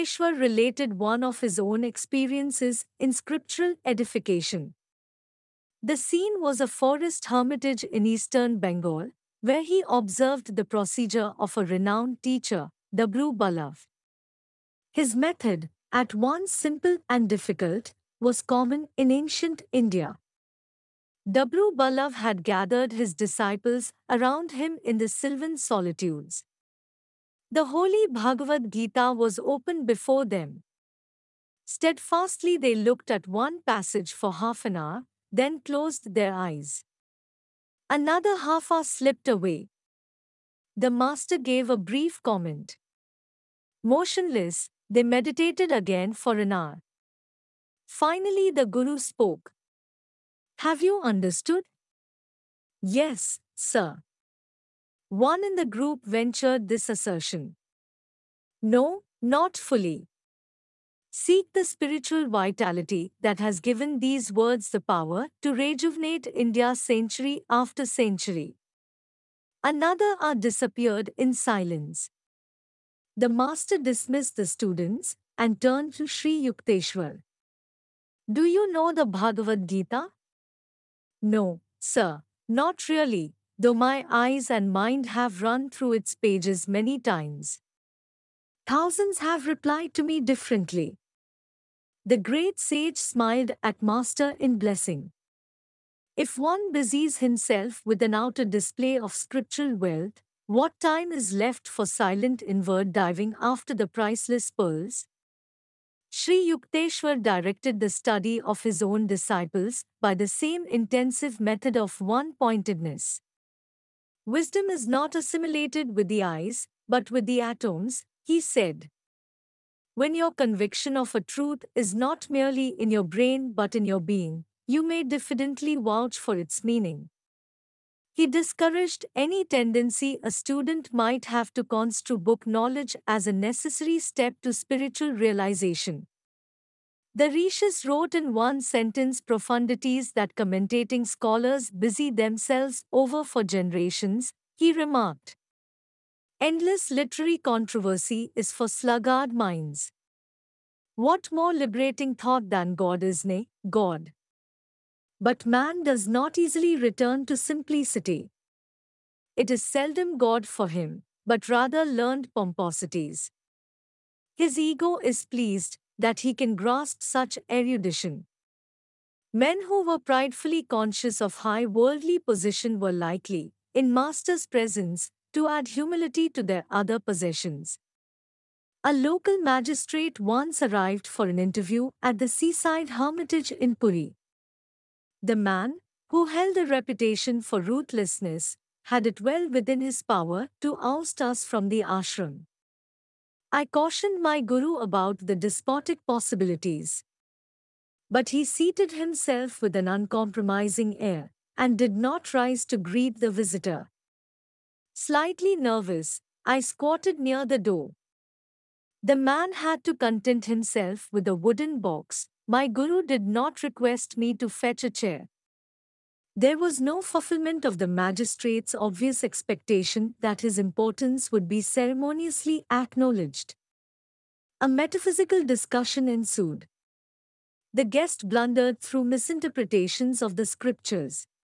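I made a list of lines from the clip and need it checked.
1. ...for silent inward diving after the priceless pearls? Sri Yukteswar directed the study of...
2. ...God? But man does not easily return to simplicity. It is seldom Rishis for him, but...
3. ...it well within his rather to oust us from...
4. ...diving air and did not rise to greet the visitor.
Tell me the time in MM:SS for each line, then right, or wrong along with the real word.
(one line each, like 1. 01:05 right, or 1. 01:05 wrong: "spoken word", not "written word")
1. 01:41 right
2. 02:33 wrong: "God", not "Rishis"
3. 03:09 wrong: "power", not "rather"
4. 03:19 wrong: "uncompromising", not "diving".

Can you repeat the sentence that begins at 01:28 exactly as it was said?
Thousands have replied to me differently.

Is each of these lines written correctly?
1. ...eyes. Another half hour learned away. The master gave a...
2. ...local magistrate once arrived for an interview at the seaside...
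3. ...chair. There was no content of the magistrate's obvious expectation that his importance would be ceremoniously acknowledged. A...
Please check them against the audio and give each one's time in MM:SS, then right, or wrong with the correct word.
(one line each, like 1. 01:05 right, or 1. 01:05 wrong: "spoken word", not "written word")
1. 00:36 wrong: "slipped", not "learned"
2. 02:58 right
3. 03:34 wrong: "fulfillment", not "content".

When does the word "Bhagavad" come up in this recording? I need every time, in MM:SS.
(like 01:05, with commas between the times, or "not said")
00:28, 01:19.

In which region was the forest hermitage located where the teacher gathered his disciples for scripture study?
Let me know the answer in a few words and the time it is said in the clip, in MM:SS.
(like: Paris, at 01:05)
eastern Bengal, at 00:08.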